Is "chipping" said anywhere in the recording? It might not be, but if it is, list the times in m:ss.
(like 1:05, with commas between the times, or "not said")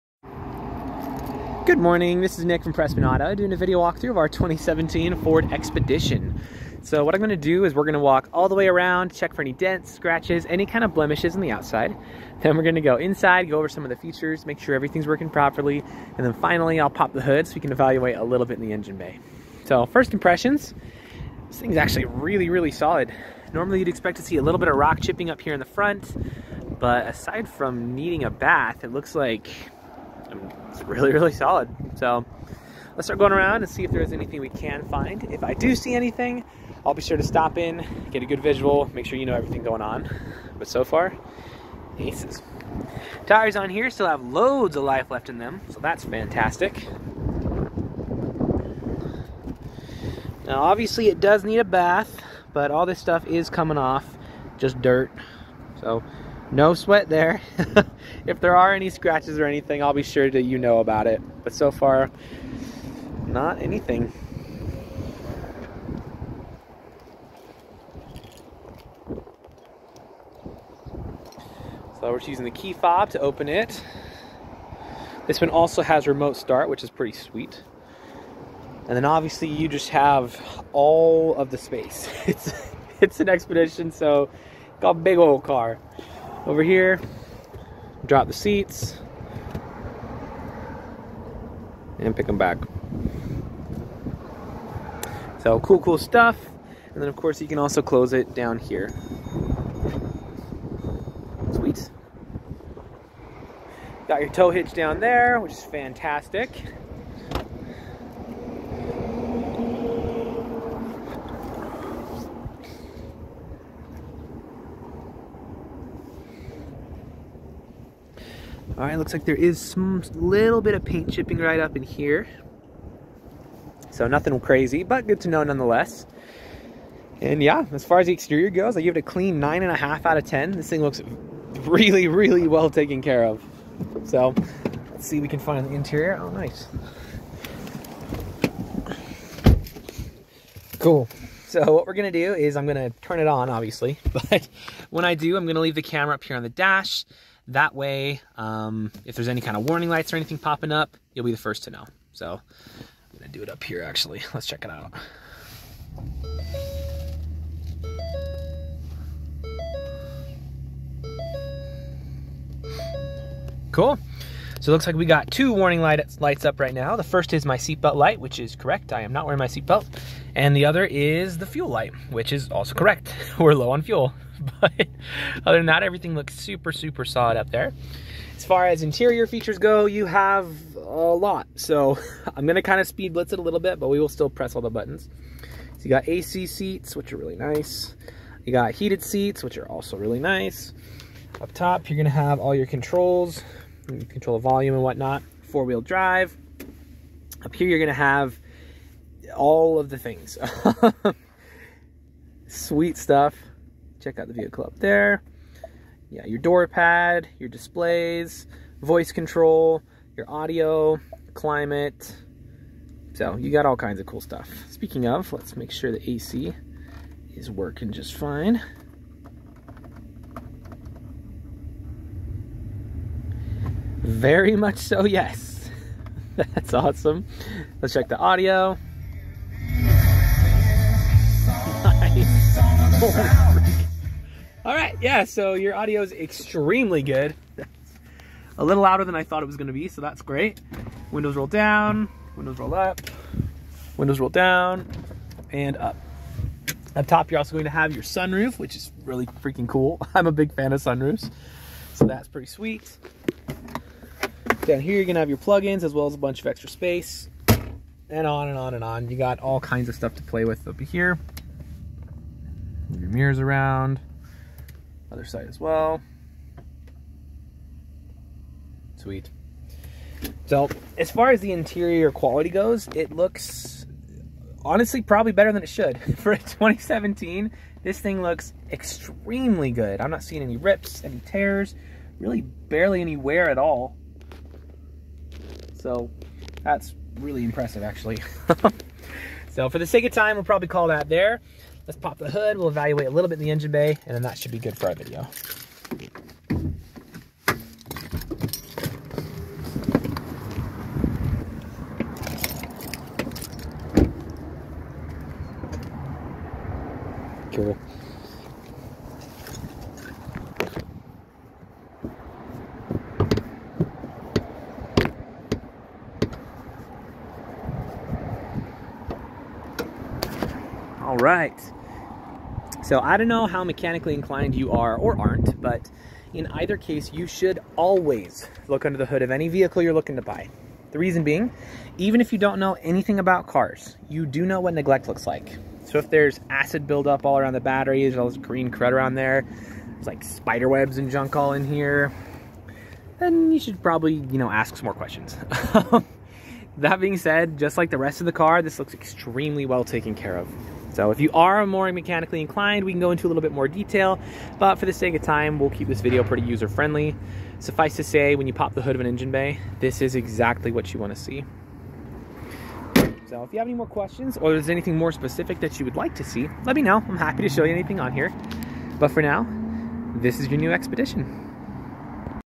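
0:24, 2:01.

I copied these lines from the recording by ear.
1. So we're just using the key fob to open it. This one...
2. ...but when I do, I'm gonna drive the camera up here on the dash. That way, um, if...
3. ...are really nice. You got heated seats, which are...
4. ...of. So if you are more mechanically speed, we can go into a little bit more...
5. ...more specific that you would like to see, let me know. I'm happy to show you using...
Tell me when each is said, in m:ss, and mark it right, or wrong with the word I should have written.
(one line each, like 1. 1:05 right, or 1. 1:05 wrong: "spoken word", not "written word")
1. 1:11 right
2. 2:24 wrong: "leave", not "drive"
3. 3:07 right
4. 5:50 wrong: "inclined", not "speed"
5. 6:04 wrong: "anything", not "using".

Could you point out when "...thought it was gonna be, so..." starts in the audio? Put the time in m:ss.
3:59.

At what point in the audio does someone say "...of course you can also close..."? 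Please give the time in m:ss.
1:37.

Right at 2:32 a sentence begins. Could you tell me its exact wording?
So I'm gonna do it up here actually.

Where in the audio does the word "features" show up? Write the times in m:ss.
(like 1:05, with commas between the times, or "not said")
0:13, 2:59.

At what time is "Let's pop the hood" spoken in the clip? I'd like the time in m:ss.
4:51.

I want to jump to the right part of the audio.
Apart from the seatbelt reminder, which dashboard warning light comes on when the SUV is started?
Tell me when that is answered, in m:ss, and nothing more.
2:51.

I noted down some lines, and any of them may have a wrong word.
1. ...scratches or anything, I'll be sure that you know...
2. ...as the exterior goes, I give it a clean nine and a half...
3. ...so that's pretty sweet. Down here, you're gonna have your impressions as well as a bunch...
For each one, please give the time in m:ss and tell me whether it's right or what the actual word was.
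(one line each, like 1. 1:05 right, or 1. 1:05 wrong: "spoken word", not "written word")
1. 0:58 right
2. 2:07 right
3. 4:11 wrong: "plugins", not "impressions".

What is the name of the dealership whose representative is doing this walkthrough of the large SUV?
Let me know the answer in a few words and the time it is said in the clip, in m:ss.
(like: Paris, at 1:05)
Prestman Auto, at 0:02.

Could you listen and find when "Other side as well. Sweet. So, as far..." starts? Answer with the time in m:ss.
4:25.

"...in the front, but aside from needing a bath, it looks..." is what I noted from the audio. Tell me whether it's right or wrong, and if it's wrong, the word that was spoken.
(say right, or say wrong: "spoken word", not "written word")
right.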